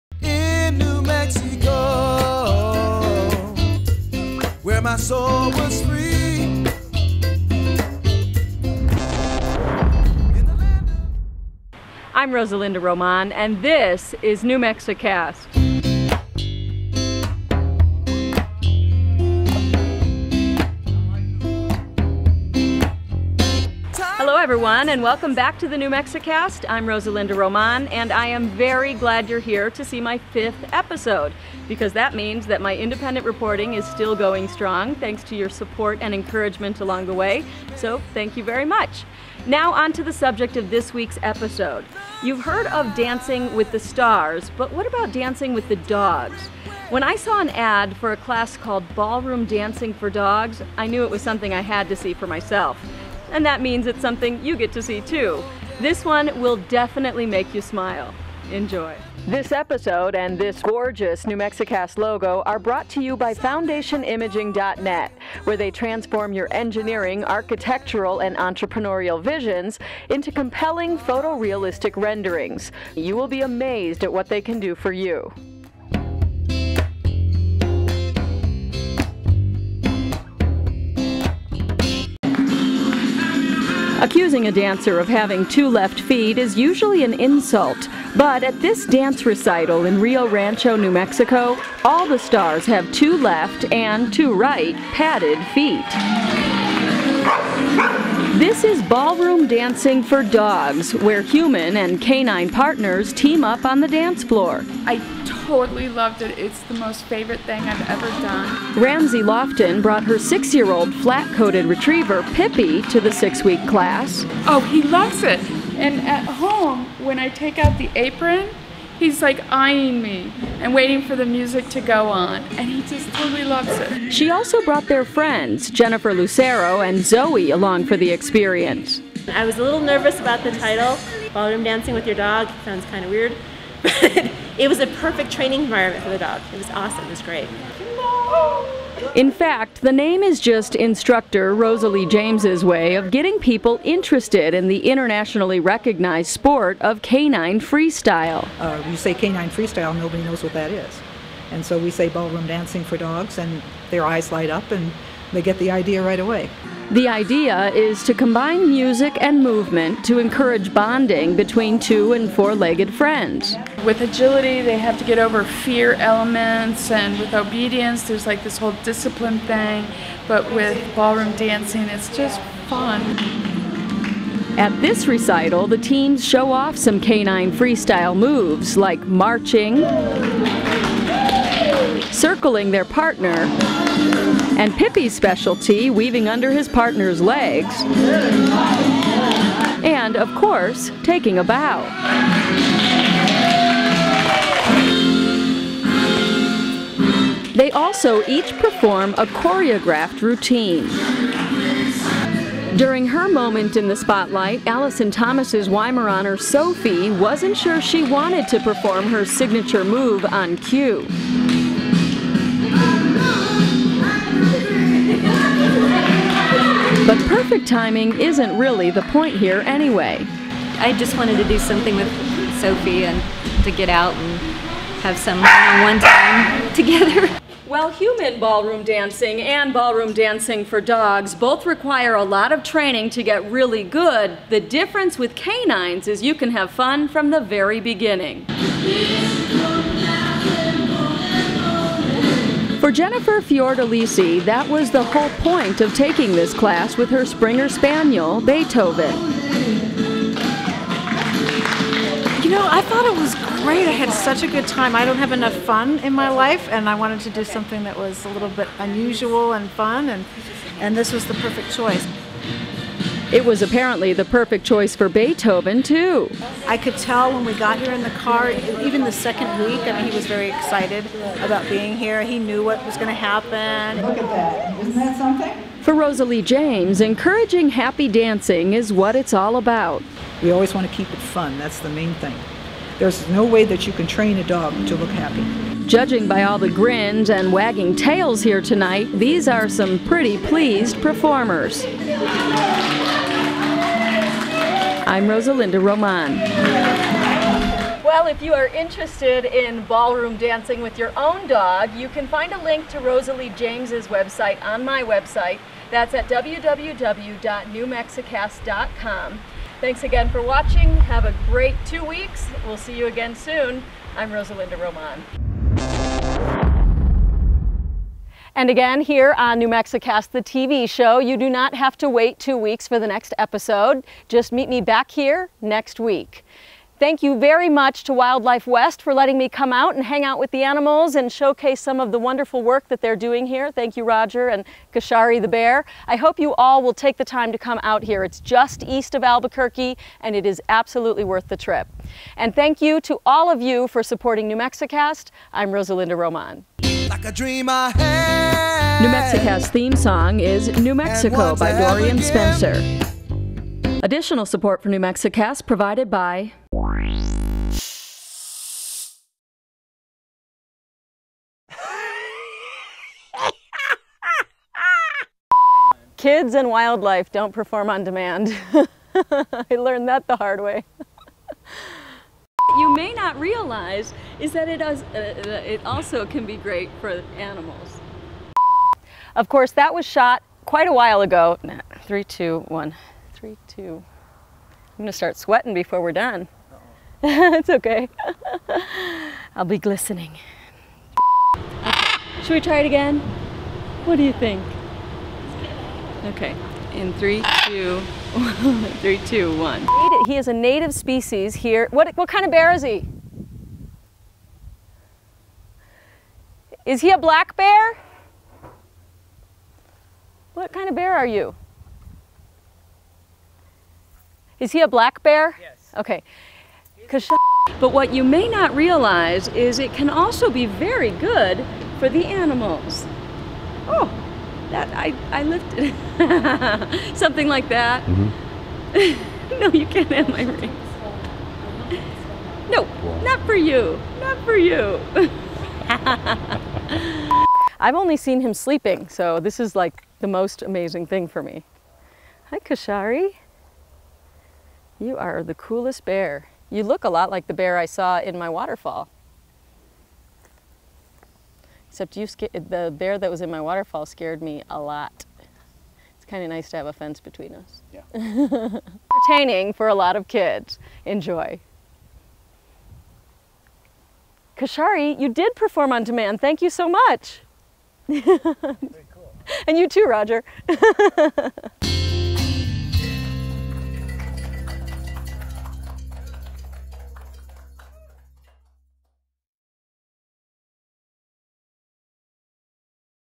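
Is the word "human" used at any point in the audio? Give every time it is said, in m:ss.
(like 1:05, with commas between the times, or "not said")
1:41, 3:47.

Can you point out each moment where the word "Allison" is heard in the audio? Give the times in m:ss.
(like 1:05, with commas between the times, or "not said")
3:24.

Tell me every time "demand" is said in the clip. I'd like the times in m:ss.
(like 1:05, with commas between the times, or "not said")
6:08, 7:46.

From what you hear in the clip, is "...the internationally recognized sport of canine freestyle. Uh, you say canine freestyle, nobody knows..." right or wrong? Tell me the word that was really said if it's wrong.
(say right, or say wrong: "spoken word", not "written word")
right.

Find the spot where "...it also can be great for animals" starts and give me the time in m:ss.
6:15.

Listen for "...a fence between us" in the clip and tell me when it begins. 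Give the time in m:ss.
7:36.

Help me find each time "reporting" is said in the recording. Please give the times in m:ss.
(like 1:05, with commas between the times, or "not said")
0:33.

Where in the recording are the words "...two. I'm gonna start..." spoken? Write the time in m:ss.
6:23.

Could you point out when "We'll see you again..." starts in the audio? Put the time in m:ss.
5:12.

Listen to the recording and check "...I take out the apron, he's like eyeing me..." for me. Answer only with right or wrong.
right.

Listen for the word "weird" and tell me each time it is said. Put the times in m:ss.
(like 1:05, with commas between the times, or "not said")
2:13.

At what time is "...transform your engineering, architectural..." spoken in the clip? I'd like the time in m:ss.
1:05.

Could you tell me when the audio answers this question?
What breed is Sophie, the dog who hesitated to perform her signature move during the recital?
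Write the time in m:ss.
3:25.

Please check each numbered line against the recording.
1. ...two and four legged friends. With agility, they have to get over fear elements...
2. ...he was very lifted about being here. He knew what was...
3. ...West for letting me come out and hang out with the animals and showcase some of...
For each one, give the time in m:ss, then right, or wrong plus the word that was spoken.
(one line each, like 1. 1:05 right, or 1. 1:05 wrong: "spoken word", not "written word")
1. 2:41 right
2. 4:30 wrong: "excited", not "lifted"
3. 5:28 right.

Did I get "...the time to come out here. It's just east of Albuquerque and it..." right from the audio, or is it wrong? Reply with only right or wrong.
right.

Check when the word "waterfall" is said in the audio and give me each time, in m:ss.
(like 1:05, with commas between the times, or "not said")
7:28, 7:33.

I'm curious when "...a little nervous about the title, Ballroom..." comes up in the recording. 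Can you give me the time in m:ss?
2:09.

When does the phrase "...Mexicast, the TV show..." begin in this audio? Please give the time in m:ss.
5:19.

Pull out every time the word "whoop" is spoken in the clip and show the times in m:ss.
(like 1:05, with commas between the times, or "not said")
not said.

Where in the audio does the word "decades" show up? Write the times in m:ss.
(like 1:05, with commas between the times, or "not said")
not said.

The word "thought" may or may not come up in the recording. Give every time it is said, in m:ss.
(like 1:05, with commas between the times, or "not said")
4:12.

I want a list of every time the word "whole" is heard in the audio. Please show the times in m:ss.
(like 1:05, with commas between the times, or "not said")
2:48, 4:05.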